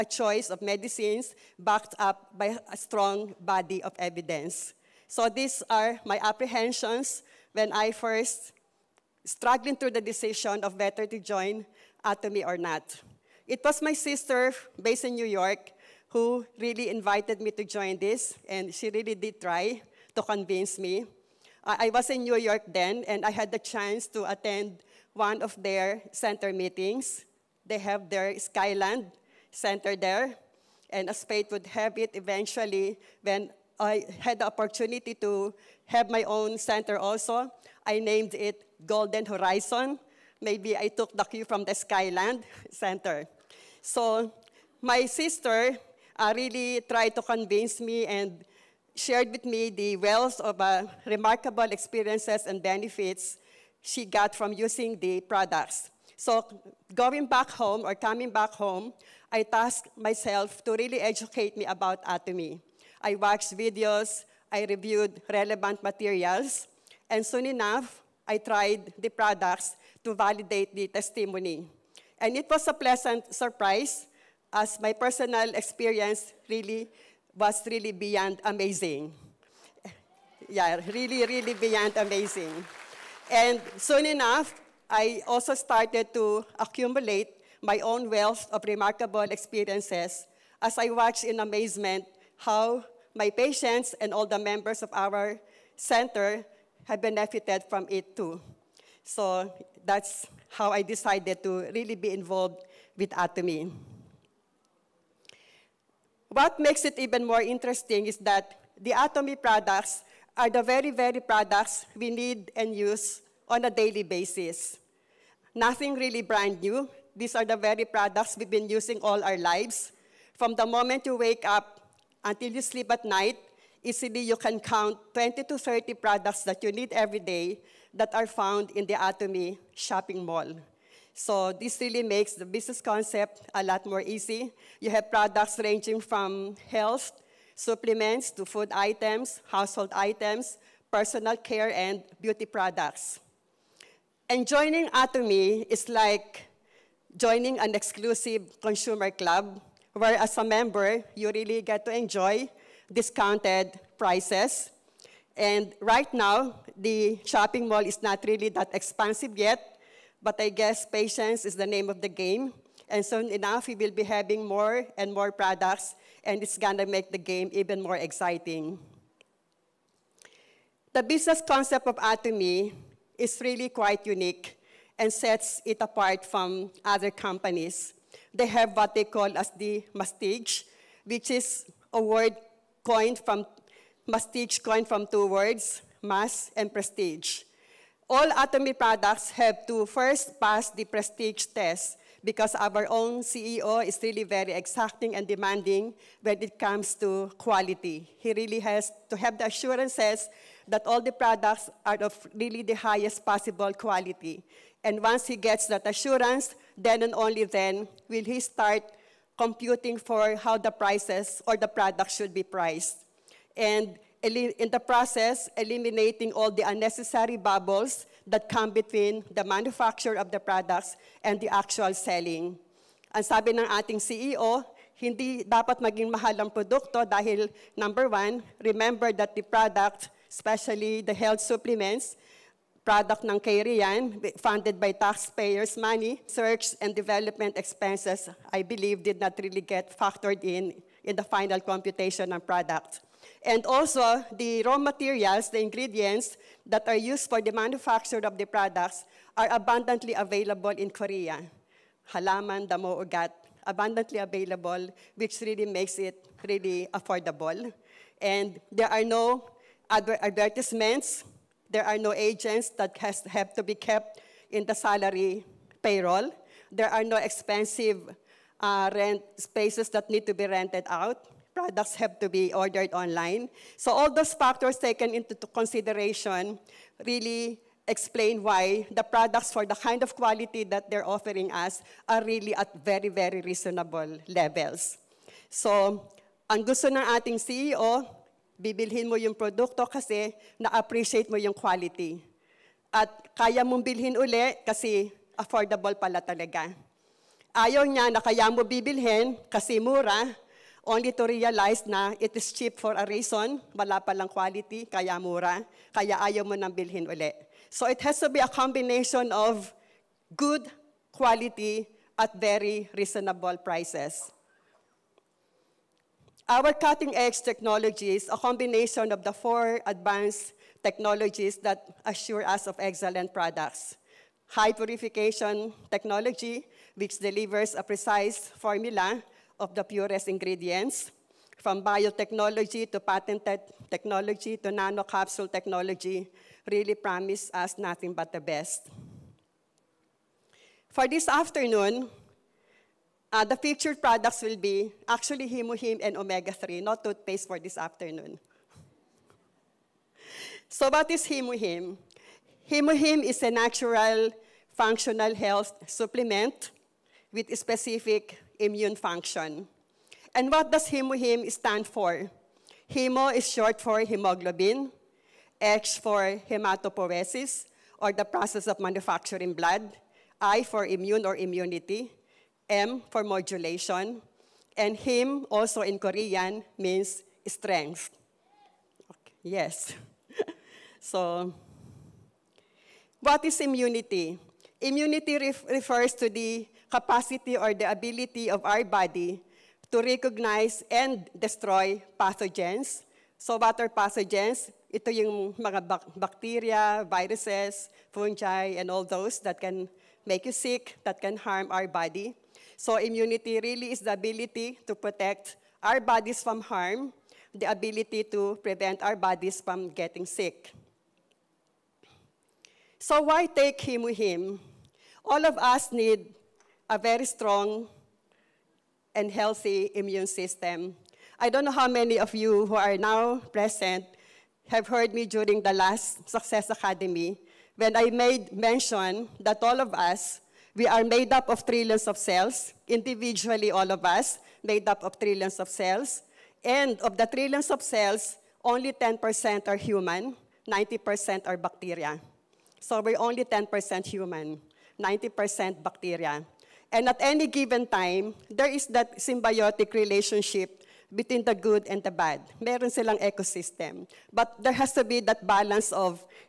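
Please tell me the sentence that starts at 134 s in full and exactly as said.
You have products ranging from health, supplements, to food items, household items, personal care, and beauty products.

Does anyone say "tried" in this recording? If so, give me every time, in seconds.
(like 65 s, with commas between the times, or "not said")
46 s, 68 s.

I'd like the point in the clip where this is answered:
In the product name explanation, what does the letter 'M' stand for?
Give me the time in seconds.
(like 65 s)
373 s.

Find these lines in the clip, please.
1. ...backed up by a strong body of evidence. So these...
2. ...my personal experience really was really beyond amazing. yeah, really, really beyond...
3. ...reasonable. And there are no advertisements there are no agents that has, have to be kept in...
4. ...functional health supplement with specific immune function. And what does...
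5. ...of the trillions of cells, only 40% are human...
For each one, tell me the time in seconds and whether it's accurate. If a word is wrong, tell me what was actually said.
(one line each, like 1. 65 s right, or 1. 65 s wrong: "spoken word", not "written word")
1. 1 s right
2. 74 s right
3. 256 s wrong: "affordable", not "reasonable"
4. 354 s right
5. 436 s wrong: "10", not "40".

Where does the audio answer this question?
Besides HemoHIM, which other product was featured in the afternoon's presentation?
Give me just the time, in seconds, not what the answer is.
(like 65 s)
346 s.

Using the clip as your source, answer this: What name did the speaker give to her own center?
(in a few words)
Golden Horizon.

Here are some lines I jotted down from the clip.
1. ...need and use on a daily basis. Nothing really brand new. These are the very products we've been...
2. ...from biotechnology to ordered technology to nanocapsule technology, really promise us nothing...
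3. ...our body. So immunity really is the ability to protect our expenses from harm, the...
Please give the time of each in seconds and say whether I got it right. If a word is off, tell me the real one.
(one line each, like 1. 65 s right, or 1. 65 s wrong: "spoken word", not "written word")
1. 112 s right
2. 331 s wrong: "patented", not "ordered"
3. 401 s wrong: "bodies", not "expenses".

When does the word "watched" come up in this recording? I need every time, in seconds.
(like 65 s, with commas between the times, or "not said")
63 s, 90 s.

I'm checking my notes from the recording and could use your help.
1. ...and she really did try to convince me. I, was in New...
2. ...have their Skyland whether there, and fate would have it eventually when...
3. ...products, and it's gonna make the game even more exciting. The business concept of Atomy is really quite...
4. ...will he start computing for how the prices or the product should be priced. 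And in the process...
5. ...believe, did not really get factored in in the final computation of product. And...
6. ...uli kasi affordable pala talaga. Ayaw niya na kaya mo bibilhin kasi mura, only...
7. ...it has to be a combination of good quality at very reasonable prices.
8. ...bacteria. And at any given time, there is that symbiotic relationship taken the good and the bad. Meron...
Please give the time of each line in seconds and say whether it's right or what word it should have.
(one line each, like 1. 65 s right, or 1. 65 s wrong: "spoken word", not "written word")
1. 18 s right
2. 27 s wrong: "center", not "whether"
3. 165 s right
4. 208 s right
5. 238 s right
6. 294 s right
7. 307 s right
8. 445 s wrong: "between", not "taken".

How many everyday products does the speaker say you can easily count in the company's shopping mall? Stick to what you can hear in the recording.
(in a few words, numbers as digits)
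20 to 30.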